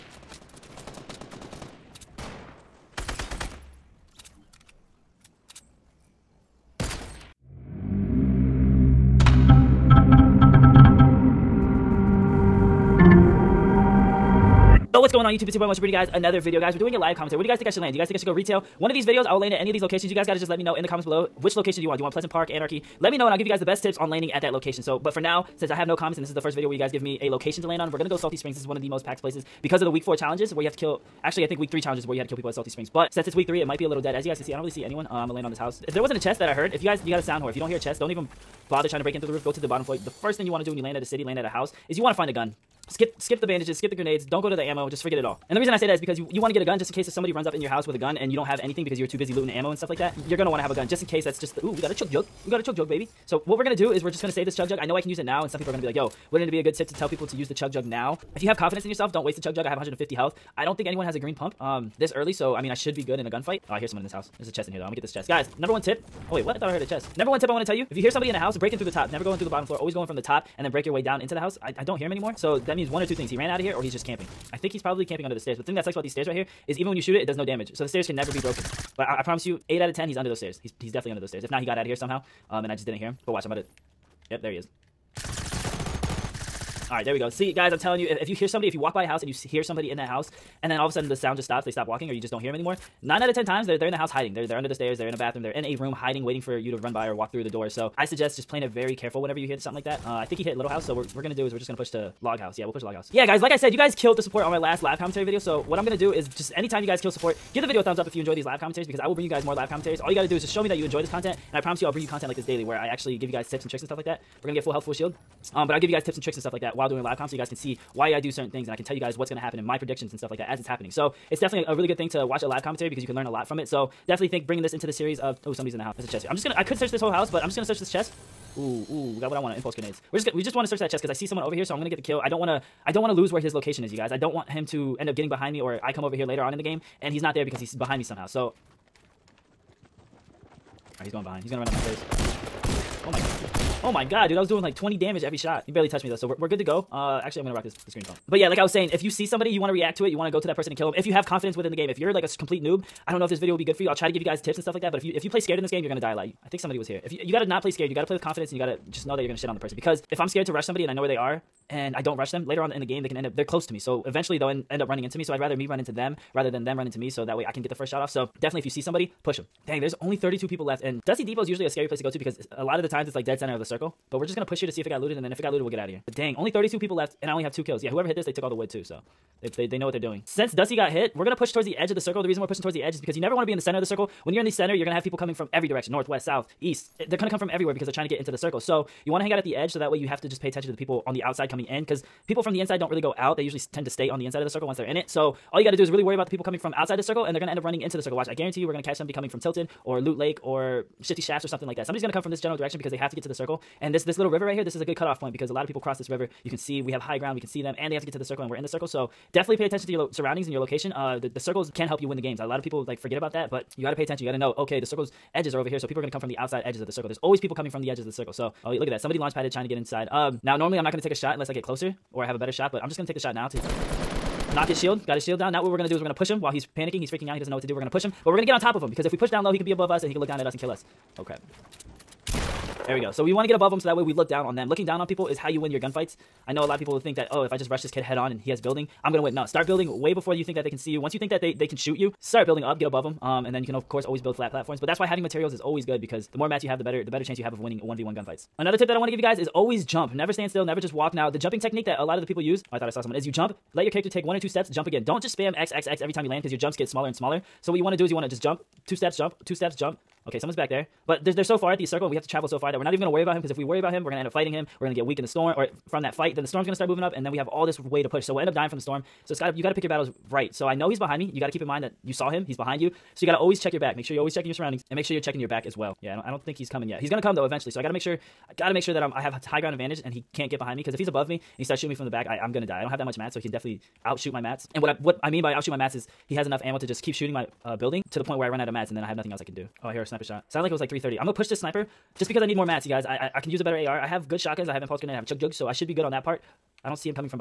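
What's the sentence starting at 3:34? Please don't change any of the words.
Okay, the circles edges are over here, so people are going to come from the outside edges of the circle.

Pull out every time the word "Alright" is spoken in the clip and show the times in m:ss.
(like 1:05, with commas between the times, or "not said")
2:20.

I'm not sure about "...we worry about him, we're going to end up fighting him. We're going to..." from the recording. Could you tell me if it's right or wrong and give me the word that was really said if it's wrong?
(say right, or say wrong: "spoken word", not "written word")
right.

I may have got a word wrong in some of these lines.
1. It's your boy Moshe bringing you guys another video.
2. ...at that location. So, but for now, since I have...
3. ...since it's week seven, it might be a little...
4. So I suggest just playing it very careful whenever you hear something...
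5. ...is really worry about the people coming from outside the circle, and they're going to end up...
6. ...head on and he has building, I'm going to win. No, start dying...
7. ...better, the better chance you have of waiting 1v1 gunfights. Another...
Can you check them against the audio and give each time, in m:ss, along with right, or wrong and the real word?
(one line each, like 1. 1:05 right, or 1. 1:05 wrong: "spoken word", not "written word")
1. 0:15 right
2. 0:24 right
3. 0:33 wrong: "three", not "seven"
4. 1:37 right
5. 3:15 right
6. 3:58 wrong: "building", not "dying"
7. 4:06 wrong: "winning", not "waiting".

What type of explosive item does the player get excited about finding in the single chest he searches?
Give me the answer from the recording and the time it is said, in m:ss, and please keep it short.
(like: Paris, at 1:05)
Impulse grenades, at 2:09.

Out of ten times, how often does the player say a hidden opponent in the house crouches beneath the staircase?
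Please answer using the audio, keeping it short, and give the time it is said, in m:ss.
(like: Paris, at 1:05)
8, at 1:19.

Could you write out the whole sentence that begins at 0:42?
Skip skip the bandages, skip the grenades, don't go to the ammo, just forget it all.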